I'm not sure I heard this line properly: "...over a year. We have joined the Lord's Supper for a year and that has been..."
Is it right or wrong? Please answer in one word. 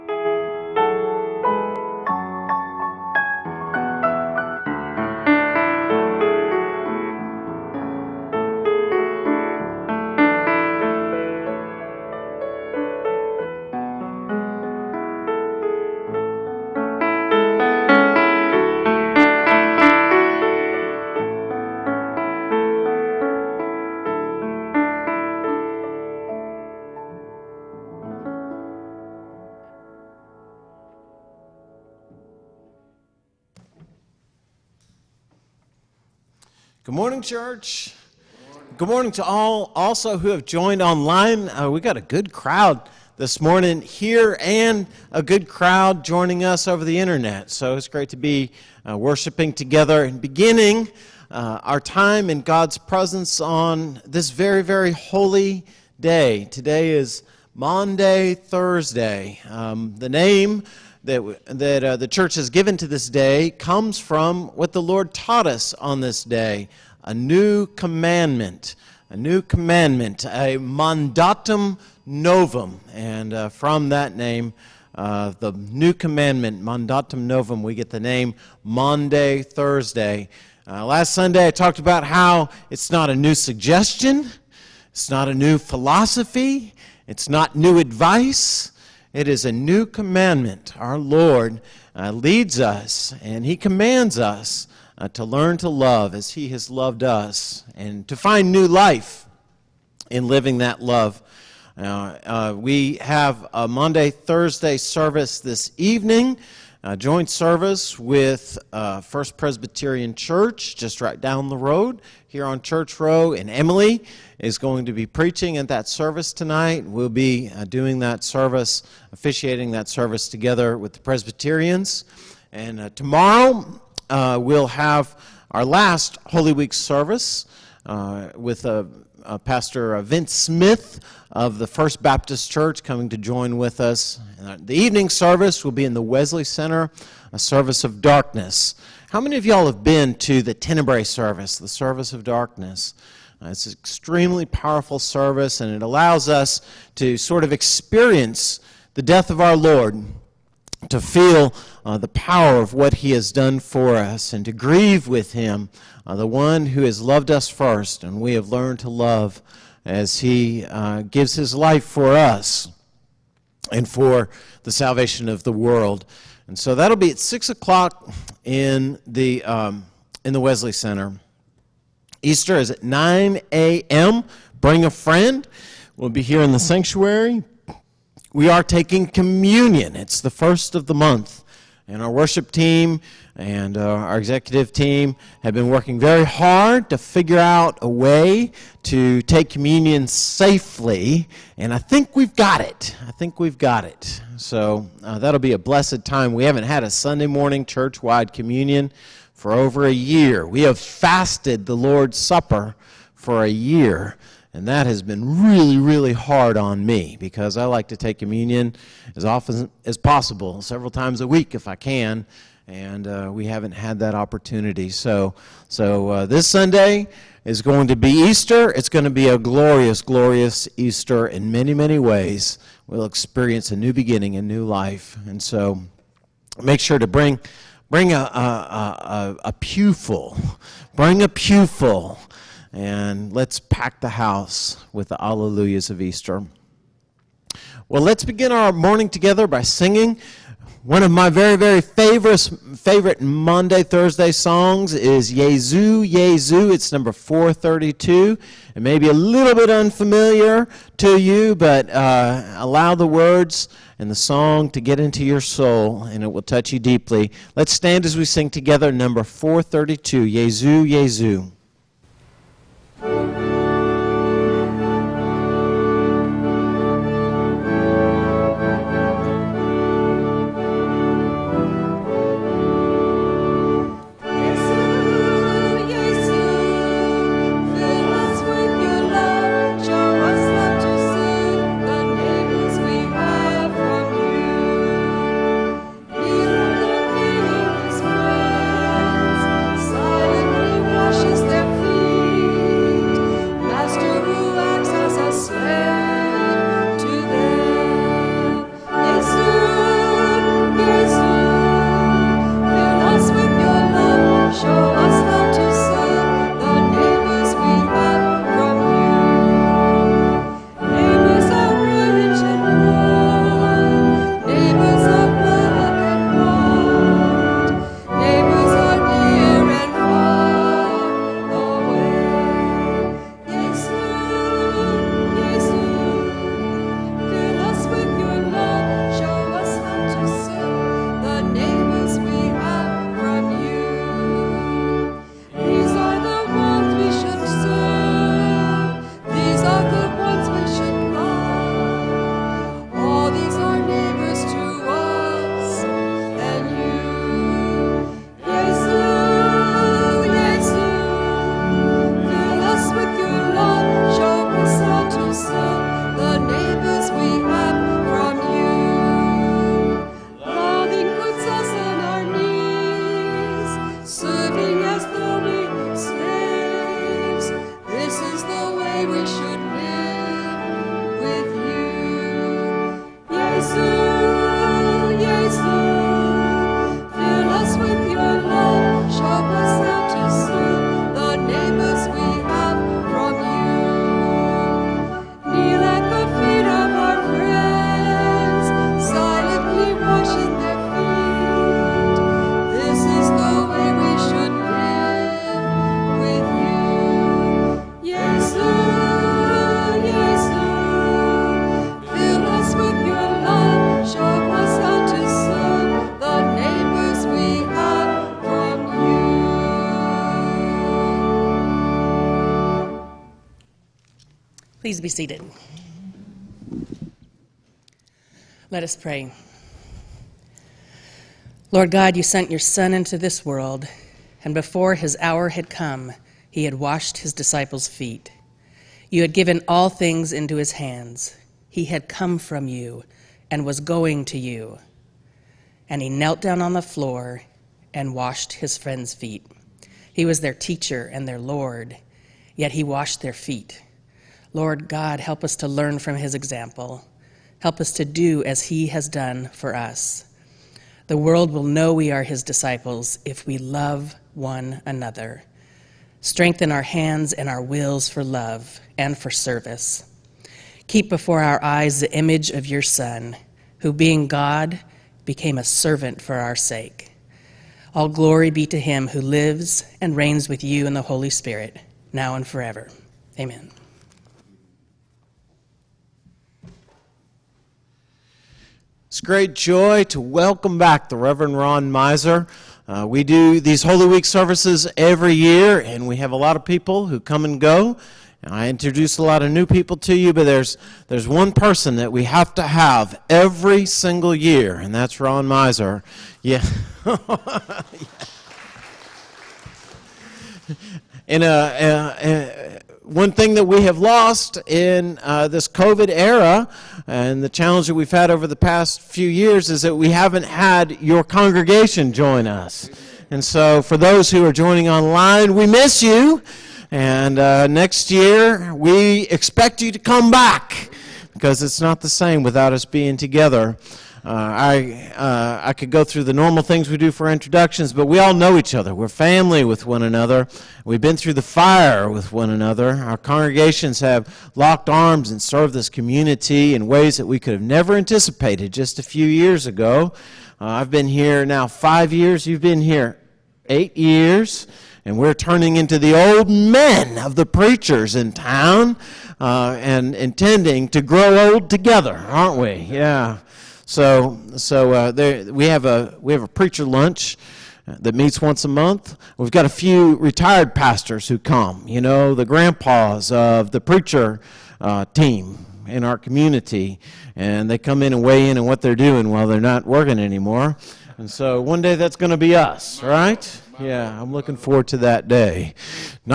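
wrong.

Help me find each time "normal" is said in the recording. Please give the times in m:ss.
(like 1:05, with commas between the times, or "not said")
8:46.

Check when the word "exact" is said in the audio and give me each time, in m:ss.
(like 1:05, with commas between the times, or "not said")
not said.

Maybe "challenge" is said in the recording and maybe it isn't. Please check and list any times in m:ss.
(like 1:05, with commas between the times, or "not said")
8:27.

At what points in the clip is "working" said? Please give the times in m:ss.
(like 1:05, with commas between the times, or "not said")
3:05, 9:29.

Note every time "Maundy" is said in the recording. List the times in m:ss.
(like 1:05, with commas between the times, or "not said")
0:57, 1:18, 1:43, 4:03.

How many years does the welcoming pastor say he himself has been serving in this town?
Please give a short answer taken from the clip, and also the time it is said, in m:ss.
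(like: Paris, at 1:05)
5, at 9:01.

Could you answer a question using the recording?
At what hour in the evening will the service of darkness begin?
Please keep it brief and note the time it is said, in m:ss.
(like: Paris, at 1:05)
6 o'clock, at 2:47.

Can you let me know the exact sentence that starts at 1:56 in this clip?
We'll be uh, doing that service, officiating that service together with the Presbyterians.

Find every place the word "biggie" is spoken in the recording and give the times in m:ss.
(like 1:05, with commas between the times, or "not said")
not said.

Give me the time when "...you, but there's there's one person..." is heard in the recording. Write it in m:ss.
8:10.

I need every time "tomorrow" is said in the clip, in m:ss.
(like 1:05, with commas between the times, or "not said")
2:02.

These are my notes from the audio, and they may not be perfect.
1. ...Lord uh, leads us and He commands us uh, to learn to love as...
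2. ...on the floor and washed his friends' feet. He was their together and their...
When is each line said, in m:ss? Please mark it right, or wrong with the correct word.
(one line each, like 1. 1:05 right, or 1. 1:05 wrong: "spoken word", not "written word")
1. 1:30 right
2. 7:16 wrong: "teacher", not "together".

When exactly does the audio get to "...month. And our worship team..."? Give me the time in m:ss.
3:00.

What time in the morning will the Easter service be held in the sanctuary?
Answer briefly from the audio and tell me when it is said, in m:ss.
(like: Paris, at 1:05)
9 a.m., at 2:52.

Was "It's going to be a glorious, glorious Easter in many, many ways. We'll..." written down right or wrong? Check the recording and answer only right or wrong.
right.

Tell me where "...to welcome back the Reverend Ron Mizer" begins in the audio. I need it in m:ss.
8:00.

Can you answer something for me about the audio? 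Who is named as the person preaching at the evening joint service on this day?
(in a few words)
Emily.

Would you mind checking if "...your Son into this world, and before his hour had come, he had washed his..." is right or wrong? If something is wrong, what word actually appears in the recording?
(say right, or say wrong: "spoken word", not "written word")
right.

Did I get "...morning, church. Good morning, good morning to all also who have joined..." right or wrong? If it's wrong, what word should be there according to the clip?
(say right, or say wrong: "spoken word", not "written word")
right.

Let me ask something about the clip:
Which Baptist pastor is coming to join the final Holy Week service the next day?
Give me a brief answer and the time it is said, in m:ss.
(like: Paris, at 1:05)
Vince Smith, at 2:10.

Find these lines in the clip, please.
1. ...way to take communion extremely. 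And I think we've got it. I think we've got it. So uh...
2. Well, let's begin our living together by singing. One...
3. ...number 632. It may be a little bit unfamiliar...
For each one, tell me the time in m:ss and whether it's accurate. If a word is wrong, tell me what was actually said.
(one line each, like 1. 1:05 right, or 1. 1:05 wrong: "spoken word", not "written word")
1. 3:07 wrong: "safely", not "extremely"
2. 3:57 wrong: "morning", not "living"
3. 4:06 wrong: "432", not "632".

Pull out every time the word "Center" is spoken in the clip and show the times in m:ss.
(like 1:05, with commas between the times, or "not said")
2:16, 2:50.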